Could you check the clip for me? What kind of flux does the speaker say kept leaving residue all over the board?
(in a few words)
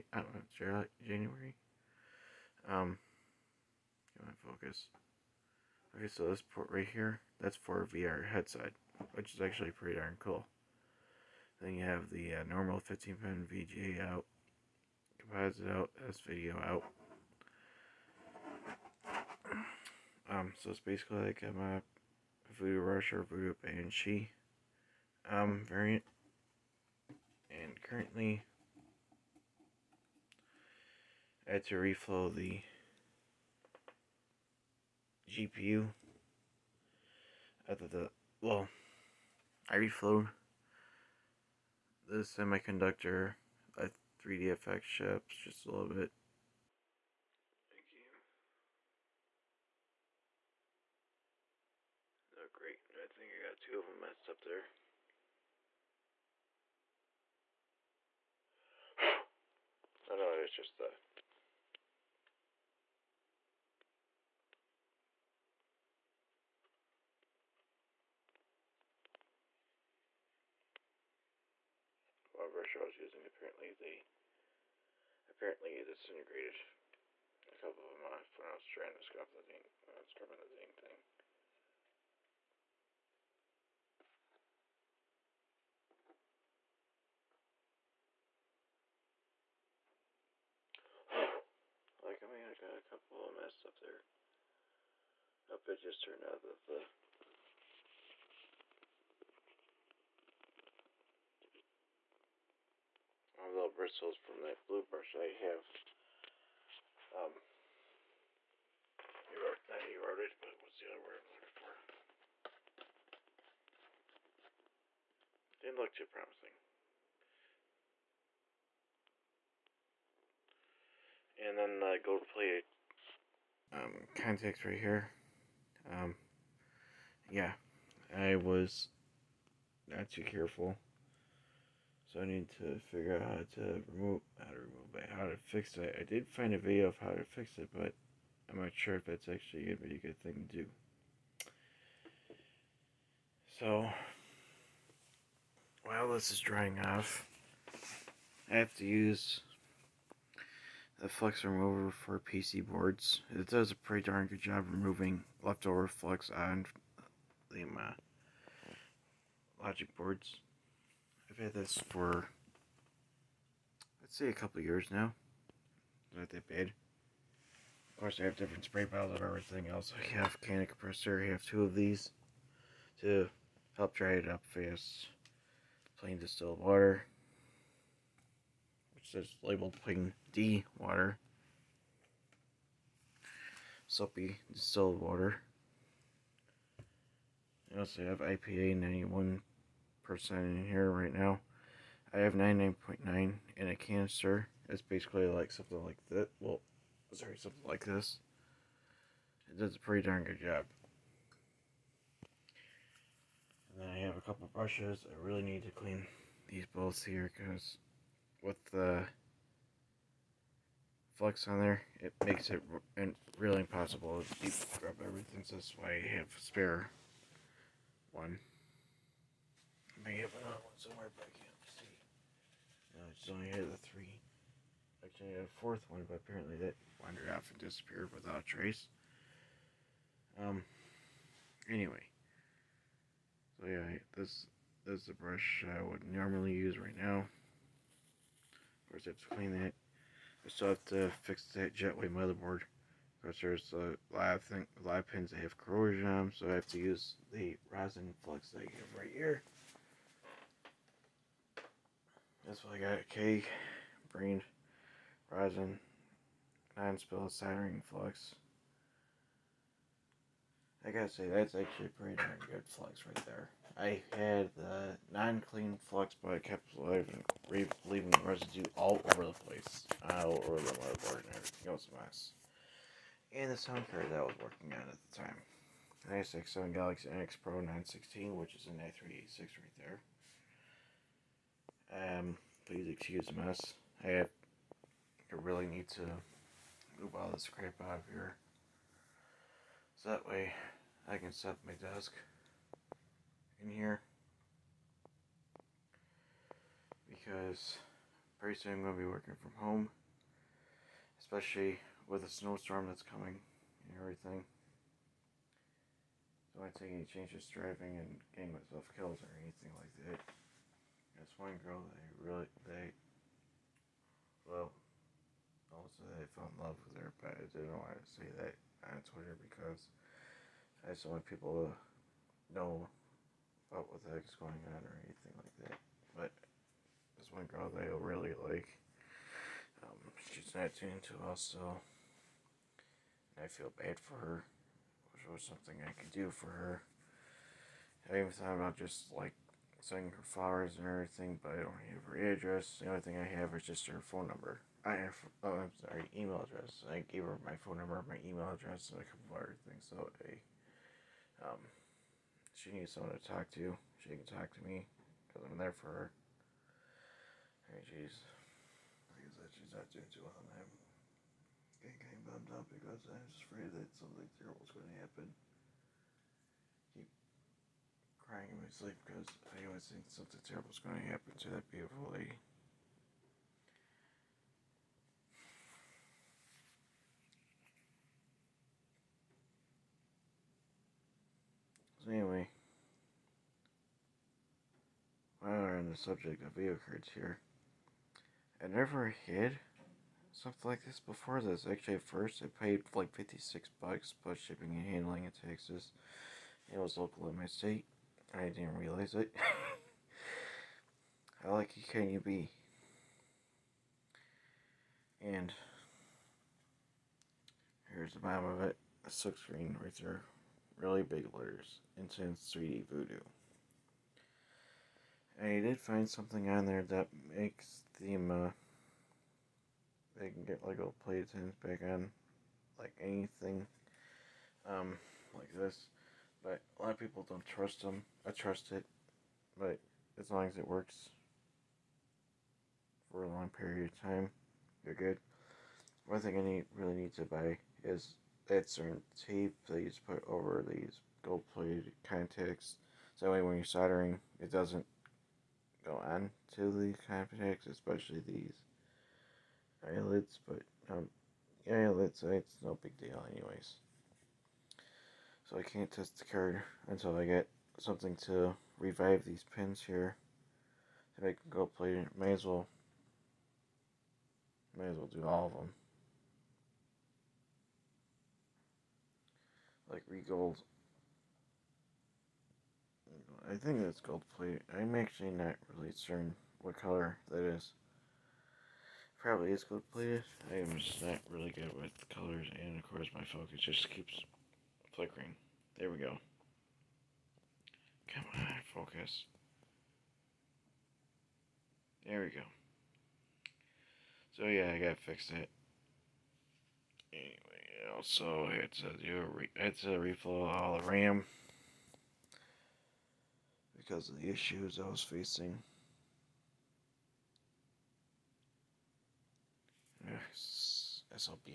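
non-clean flux.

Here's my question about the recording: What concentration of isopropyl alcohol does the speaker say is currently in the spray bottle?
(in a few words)
91%.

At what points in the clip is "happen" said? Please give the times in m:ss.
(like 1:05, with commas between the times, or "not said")
6:05, 6:11.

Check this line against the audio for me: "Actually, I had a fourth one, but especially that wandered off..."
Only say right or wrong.
wrong.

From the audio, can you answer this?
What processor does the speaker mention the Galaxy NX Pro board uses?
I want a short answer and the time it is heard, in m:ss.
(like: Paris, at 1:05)
i386, at 4:38.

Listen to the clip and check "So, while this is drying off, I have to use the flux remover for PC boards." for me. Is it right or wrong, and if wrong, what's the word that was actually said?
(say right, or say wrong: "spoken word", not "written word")
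right.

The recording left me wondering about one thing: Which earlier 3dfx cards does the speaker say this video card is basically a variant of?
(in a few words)
Voodoo Rush or Voodoo Banshee.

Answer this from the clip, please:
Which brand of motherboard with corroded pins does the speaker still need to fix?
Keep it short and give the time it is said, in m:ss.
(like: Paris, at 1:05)
Jetway, at 4:01.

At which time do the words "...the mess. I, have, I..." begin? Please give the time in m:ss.
4:43.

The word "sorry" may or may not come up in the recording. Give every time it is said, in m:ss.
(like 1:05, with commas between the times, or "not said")
3:17, 5:45.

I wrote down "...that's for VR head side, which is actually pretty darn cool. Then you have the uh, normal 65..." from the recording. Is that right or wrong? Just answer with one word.
wrong.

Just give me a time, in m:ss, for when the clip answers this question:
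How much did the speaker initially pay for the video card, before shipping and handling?
6:33.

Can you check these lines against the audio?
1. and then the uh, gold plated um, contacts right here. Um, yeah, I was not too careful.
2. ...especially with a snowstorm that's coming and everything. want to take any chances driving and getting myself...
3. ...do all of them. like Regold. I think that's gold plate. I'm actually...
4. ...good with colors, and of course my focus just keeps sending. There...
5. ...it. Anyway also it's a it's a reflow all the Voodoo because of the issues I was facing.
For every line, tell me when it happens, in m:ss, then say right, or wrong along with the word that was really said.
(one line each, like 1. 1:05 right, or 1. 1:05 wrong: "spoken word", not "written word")
1. 2:01 right
2. 5:01 right
3. 7:45 right
4. 8:01 wrong: "flickering", not "sending"
5. 8:15 wrong: "RAM", not "Voodoo".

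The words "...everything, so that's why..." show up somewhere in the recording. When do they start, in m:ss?
3:35.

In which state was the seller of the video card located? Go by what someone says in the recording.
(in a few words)
Texas.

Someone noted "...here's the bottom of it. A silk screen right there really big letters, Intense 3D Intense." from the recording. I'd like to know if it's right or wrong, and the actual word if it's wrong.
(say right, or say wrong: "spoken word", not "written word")
wrong: "Voodoo", not "Intense".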